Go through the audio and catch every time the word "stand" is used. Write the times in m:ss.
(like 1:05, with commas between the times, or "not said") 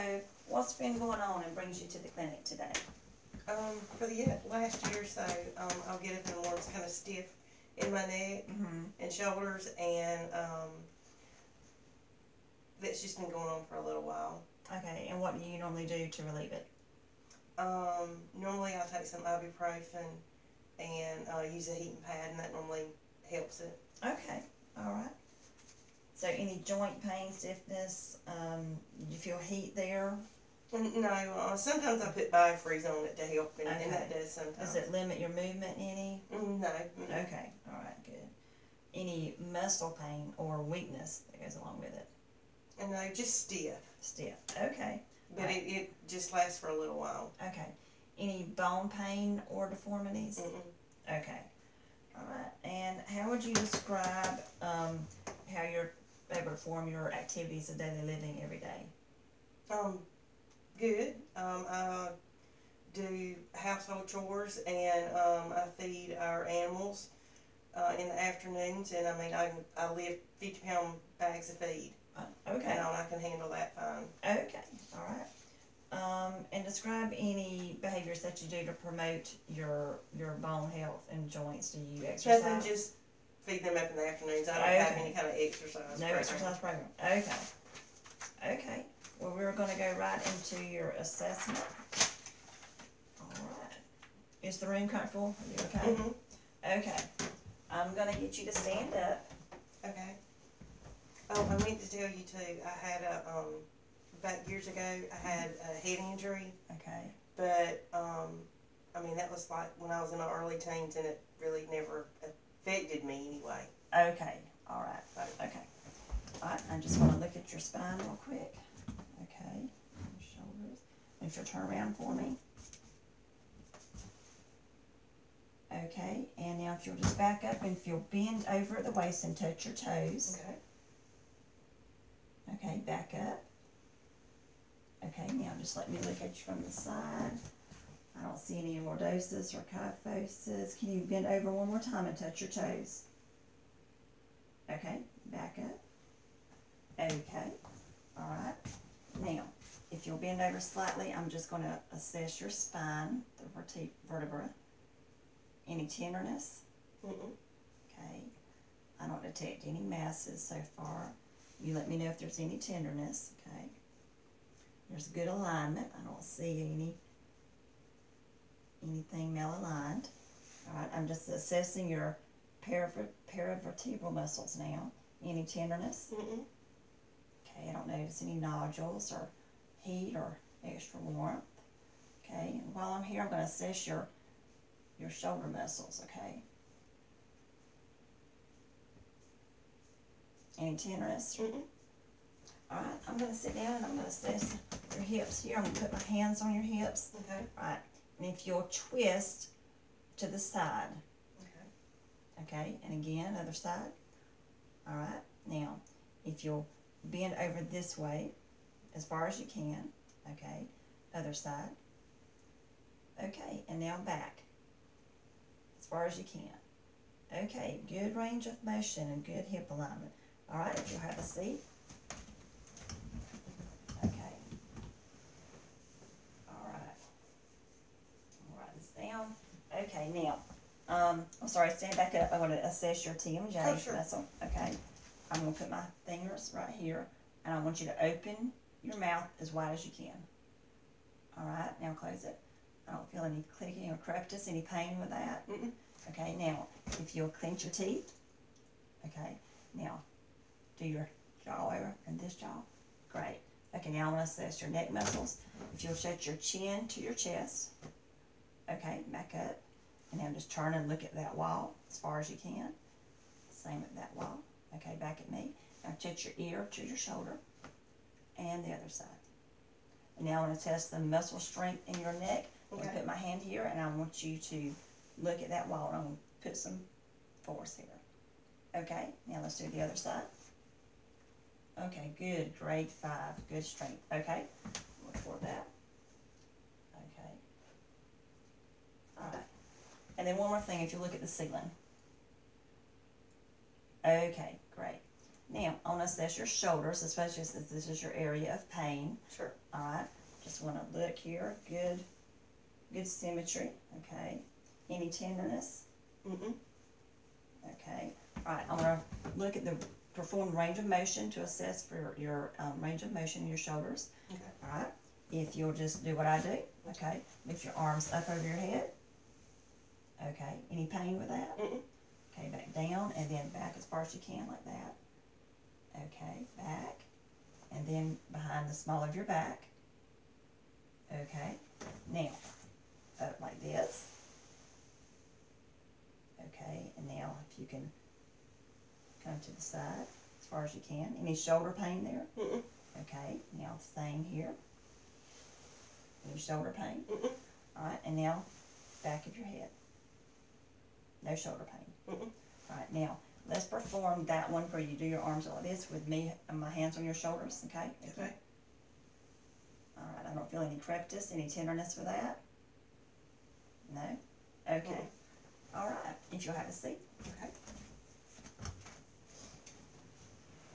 1:38, 3:51.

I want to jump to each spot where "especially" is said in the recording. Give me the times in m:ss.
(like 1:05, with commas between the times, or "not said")
4:57.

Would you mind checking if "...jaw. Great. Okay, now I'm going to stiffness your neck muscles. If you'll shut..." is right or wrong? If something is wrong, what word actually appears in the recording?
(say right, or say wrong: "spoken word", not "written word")
wrong: "assess", not "stiffness".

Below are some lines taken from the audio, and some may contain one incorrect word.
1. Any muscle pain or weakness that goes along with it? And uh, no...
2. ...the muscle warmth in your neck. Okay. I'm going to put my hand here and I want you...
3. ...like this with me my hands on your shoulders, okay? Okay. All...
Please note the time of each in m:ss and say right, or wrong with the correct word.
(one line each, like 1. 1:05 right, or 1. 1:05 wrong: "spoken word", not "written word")
1. 0:38 right
2. 4:30 wrong: "strength", not "warmth"
3. 5:55 right.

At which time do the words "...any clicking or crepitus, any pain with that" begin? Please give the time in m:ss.
4:03.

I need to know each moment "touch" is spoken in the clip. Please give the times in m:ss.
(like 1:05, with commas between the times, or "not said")
2:09, 2:22, 4:26.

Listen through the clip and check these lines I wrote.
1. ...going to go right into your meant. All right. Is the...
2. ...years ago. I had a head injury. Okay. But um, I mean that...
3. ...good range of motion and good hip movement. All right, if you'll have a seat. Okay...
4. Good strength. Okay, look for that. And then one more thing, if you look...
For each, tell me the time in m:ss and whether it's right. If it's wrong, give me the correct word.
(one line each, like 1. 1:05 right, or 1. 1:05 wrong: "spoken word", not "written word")
1. 1:29 wrong: "assessment", not "meant"
2. 1:44 right
3. 3:37 wrong: "alignment", not "movement"
4. 4:43 right.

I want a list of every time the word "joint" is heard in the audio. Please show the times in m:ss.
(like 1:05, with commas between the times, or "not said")
0:26, 1:21.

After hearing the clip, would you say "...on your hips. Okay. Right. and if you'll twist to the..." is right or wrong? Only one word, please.
right.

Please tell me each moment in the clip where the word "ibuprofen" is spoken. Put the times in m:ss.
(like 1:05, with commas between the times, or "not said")
0:19.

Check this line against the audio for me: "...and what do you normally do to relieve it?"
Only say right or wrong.
right.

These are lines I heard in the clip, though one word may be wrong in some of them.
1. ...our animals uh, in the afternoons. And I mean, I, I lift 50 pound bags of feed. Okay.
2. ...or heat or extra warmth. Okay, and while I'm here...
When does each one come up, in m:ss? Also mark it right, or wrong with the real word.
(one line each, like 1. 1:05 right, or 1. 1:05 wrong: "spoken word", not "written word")
1. 1:06 right
2. 2:59 right.